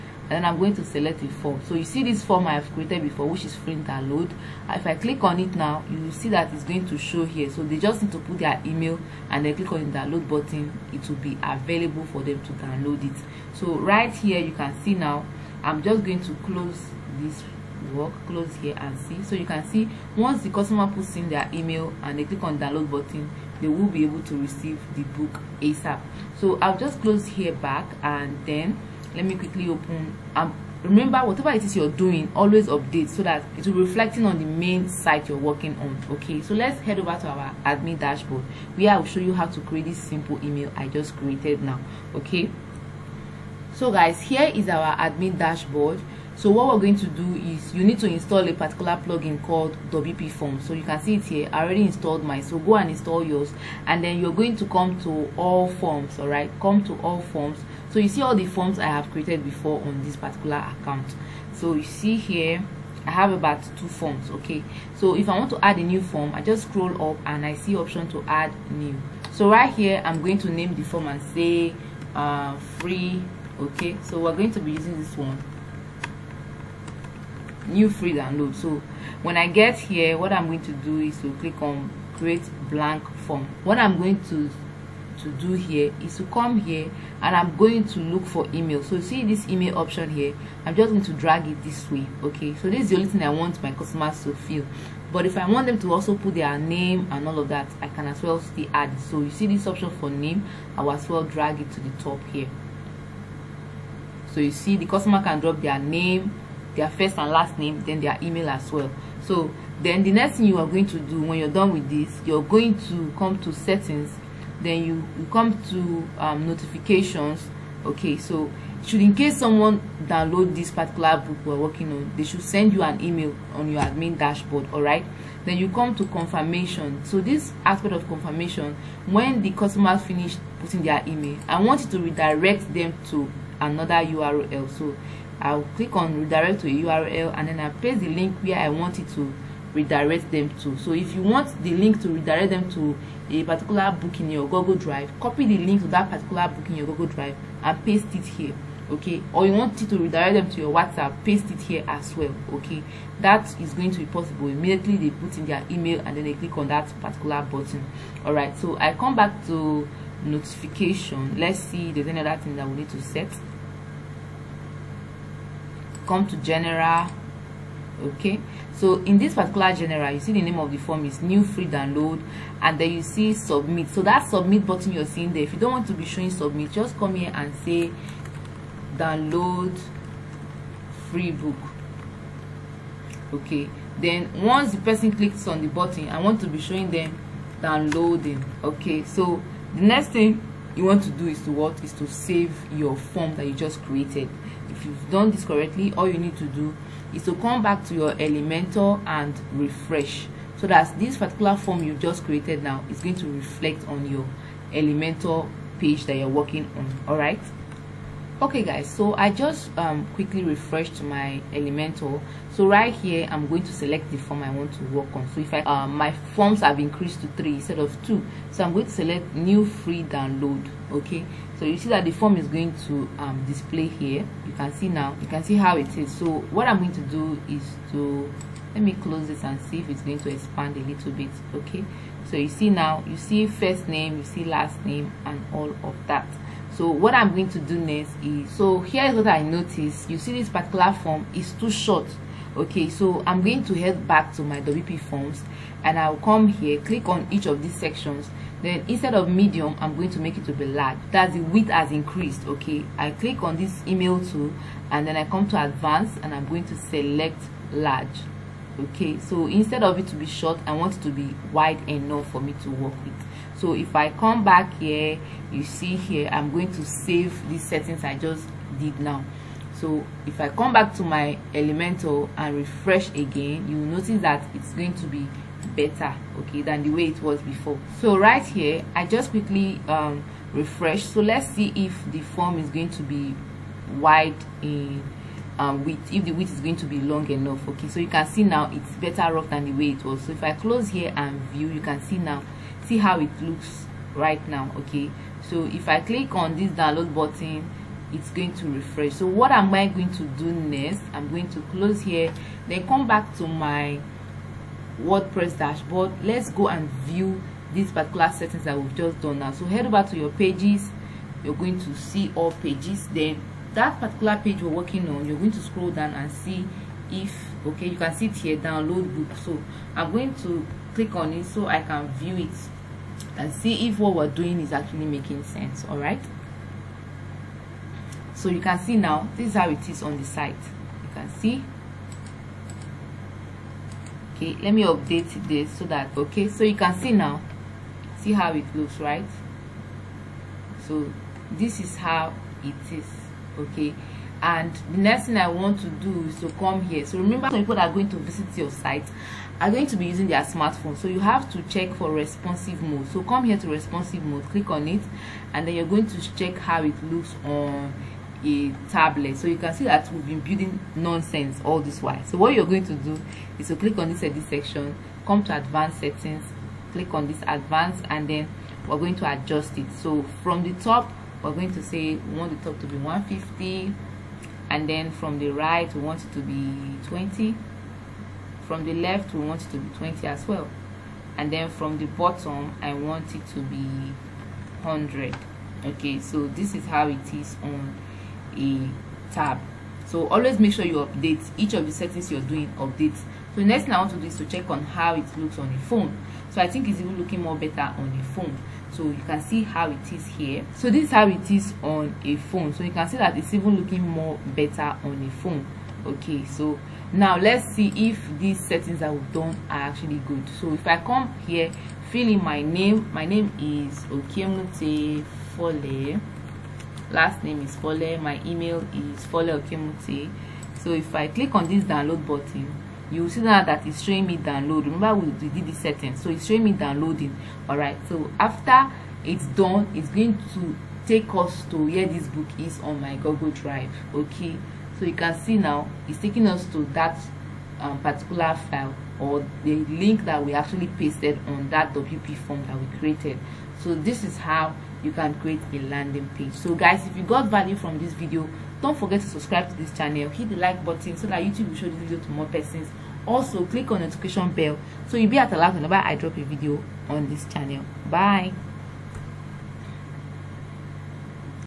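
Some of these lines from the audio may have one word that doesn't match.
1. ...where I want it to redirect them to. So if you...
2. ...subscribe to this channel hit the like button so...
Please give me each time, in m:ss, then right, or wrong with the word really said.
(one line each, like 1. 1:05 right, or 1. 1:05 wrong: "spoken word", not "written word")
1. 2:18 right
2. 7:29 right.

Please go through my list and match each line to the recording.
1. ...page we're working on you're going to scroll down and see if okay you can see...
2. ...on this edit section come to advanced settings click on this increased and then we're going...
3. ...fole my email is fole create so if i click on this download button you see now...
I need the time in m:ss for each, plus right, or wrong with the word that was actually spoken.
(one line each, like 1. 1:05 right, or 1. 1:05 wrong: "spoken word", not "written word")
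1. 5:14 right
2. 6:03 wrong: "advanced", not "increased"
3. 6:57 wrong: "okiemute", not "create".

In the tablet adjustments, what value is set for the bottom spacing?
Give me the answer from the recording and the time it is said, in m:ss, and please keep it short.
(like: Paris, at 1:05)
100, at 6:24.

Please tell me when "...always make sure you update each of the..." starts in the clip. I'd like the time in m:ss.
6:30.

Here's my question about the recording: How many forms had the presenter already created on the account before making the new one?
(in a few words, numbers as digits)
2.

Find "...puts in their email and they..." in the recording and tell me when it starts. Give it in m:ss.
0:20.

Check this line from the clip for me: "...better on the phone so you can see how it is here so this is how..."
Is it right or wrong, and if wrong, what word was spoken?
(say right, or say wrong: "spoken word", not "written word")
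right.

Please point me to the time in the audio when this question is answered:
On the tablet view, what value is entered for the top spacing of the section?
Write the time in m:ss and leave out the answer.
6:12.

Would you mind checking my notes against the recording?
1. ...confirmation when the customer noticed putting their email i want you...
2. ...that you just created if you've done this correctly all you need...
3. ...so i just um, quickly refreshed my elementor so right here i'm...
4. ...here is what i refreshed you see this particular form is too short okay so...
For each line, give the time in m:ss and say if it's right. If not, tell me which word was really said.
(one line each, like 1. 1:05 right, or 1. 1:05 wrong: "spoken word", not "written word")
1. 2:08 wrong: "finished", not "noticed"
2. 3:13 right
3. 3:28 right
4. 3:58 wrong: "noticed", not "refreshed".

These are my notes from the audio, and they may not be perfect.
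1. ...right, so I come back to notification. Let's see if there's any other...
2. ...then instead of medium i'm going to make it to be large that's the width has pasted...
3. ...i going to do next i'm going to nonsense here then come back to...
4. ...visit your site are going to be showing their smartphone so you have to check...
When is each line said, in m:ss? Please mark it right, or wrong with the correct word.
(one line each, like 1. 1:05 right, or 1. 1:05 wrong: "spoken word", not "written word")
1. 2:38 right
2. 4:08 wrong: "increased", not "pasted"
3. 4:59 wrong: "close", not "nonsense"
4. 5:48 wrong: "using", not "showing".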